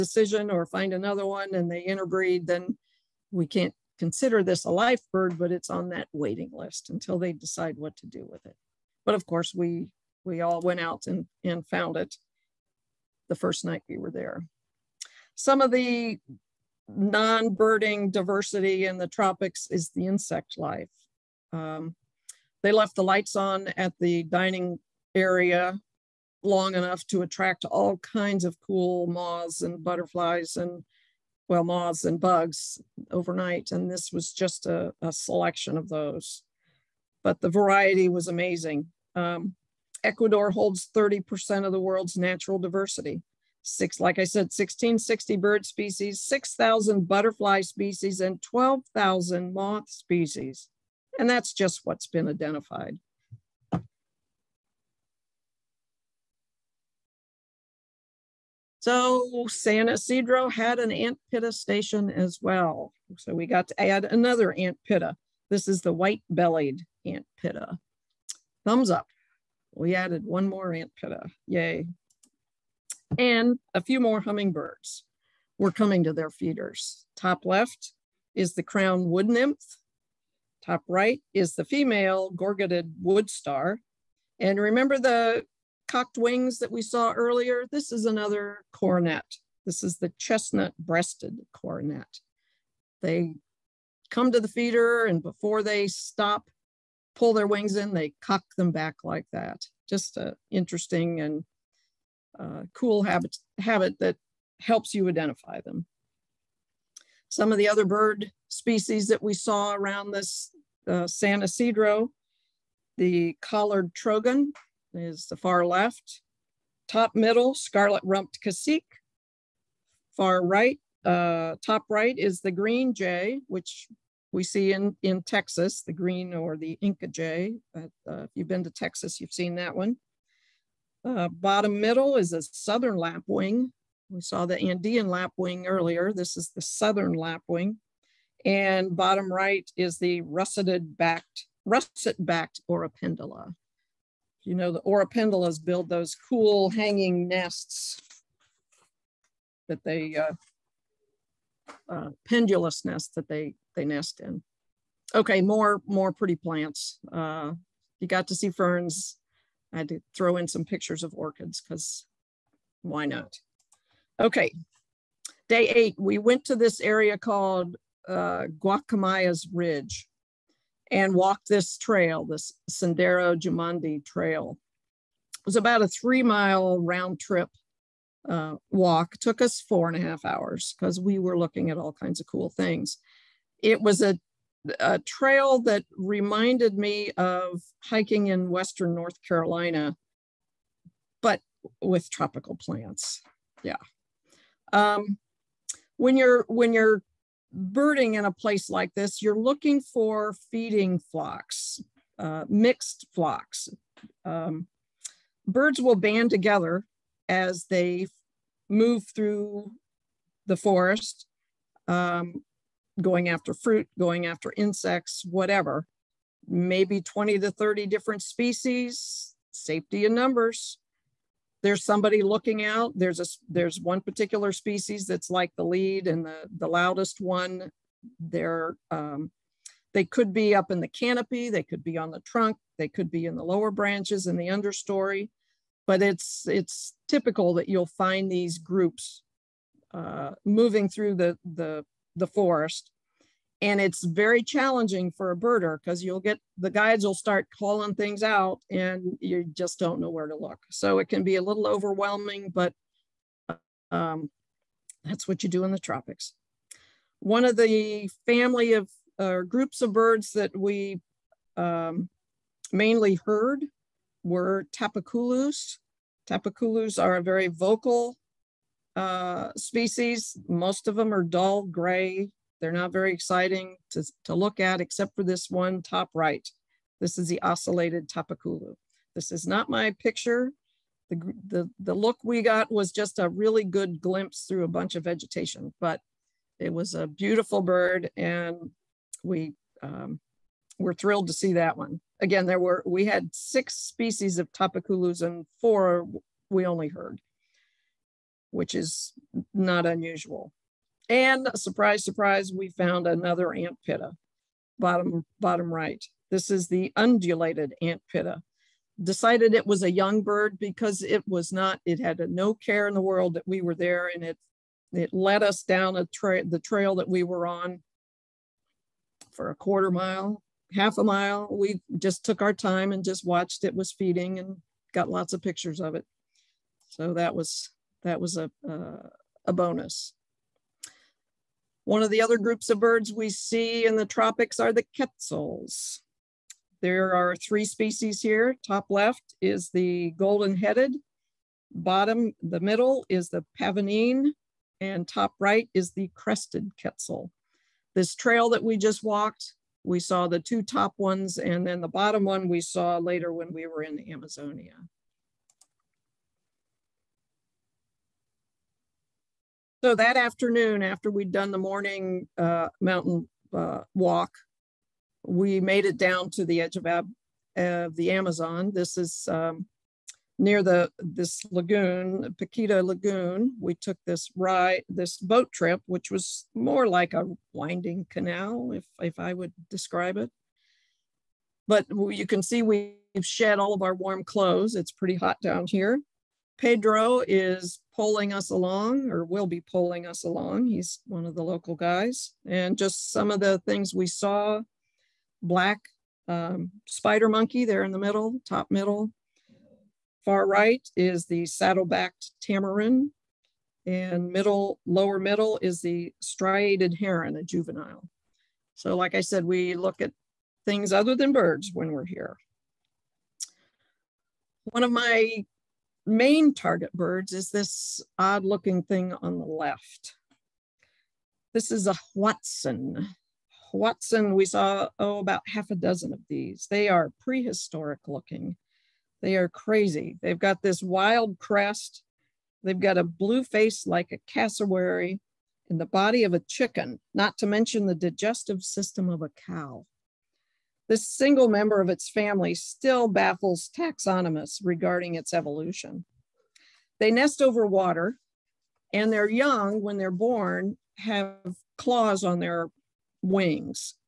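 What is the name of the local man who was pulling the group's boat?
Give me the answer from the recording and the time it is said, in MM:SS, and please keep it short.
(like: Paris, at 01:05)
Pedro, at 06:26.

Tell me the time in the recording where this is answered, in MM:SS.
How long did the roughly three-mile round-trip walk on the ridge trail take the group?
02:59.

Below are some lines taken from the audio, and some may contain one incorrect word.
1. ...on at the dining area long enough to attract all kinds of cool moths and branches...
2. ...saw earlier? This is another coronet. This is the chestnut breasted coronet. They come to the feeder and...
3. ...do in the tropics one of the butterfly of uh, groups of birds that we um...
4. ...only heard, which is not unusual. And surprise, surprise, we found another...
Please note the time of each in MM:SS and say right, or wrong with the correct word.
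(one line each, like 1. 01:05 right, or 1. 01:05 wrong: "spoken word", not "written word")
1. 00:23 wrong: "butterflies", not "branches"
2. 01:26 right
3. 04:15 wrong: "family", not "butterfly"
4. 04:56 right.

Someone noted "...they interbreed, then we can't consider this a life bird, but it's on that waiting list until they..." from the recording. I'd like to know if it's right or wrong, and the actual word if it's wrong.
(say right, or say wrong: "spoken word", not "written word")
right.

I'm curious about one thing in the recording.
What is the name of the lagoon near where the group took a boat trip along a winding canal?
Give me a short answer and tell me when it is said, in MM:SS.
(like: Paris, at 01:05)
Paquita Lagoon, at 06:12.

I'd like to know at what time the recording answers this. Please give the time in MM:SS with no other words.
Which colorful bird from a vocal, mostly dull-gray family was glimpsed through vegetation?
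04:37.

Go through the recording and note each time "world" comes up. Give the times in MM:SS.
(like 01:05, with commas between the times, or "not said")
00:41, 05:13.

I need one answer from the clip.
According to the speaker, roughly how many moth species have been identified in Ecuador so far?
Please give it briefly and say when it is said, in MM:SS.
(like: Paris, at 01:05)
12000, at 00:48.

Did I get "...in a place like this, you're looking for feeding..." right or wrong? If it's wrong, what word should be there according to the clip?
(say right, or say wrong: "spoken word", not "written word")
right.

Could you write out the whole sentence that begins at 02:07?
But, uh, if you've been to Texas, you've seen that one.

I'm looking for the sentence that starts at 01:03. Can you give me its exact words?
So we got to add another ant pitta.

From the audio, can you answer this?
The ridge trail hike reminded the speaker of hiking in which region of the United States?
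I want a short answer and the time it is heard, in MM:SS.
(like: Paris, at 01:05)
Western North Carolina, at 03:08.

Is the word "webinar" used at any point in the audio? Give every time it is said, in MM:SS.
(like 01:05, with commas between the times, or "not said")
not said.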